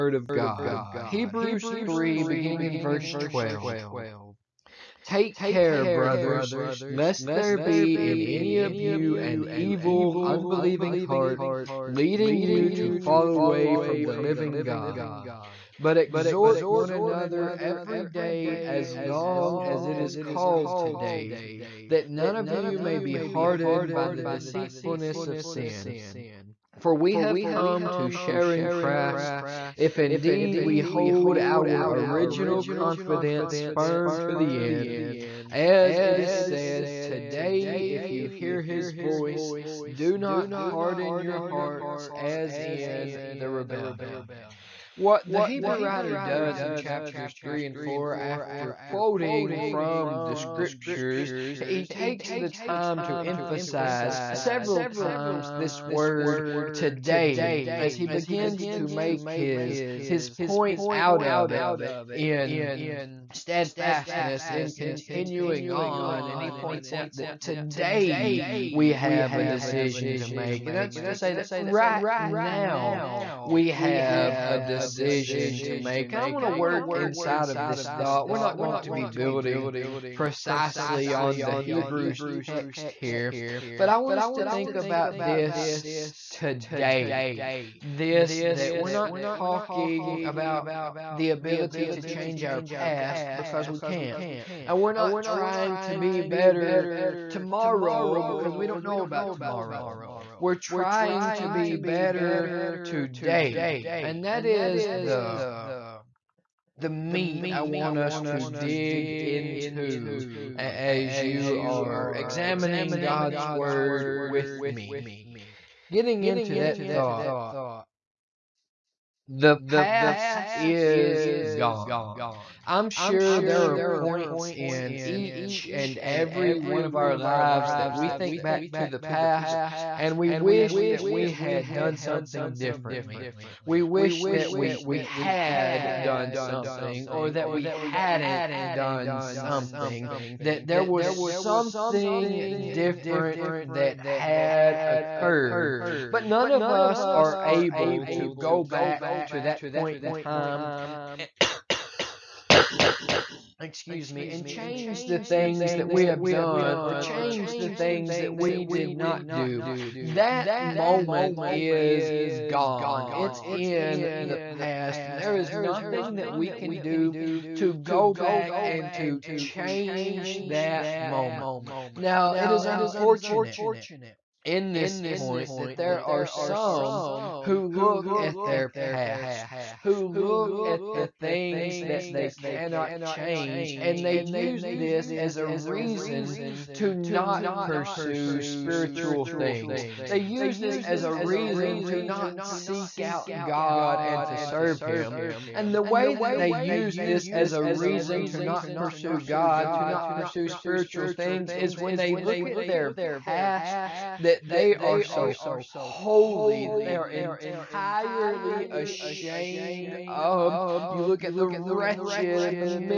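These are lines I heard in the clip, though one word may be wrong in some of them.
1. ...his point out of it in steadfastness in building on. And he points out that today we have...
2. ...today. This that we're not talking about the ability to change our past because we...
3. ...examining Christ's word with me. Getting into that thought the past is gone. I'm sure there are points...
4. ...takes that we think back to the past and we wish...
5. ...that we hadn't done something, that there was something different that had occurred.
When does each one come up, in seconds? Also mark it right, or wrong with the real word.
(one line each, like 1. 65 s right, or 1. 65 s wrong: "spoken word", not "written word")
1. 60 s wrong: "continuing", not "building"
2. 86 s right
3. 112 s wrong: "God", not "Christ"
4. 127 s wrong: "lives", not "takes"
5. 137 s right.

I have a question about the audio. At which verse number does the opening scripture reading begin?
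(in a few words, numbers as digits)
12.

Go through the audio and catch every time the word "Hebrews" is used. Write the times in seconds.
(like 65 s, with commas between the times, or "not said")
1 s, 45 s, 81 s.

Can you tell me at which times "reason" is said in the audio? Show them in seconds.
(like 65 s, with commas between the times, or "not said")
185 s, 191 s, 197 s.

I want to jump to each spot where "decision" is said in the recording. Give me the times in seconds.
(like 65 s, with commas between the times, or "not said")
69 s, 74 s.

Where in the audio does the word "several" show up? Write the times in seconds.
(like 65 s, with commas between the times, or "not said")
54 s.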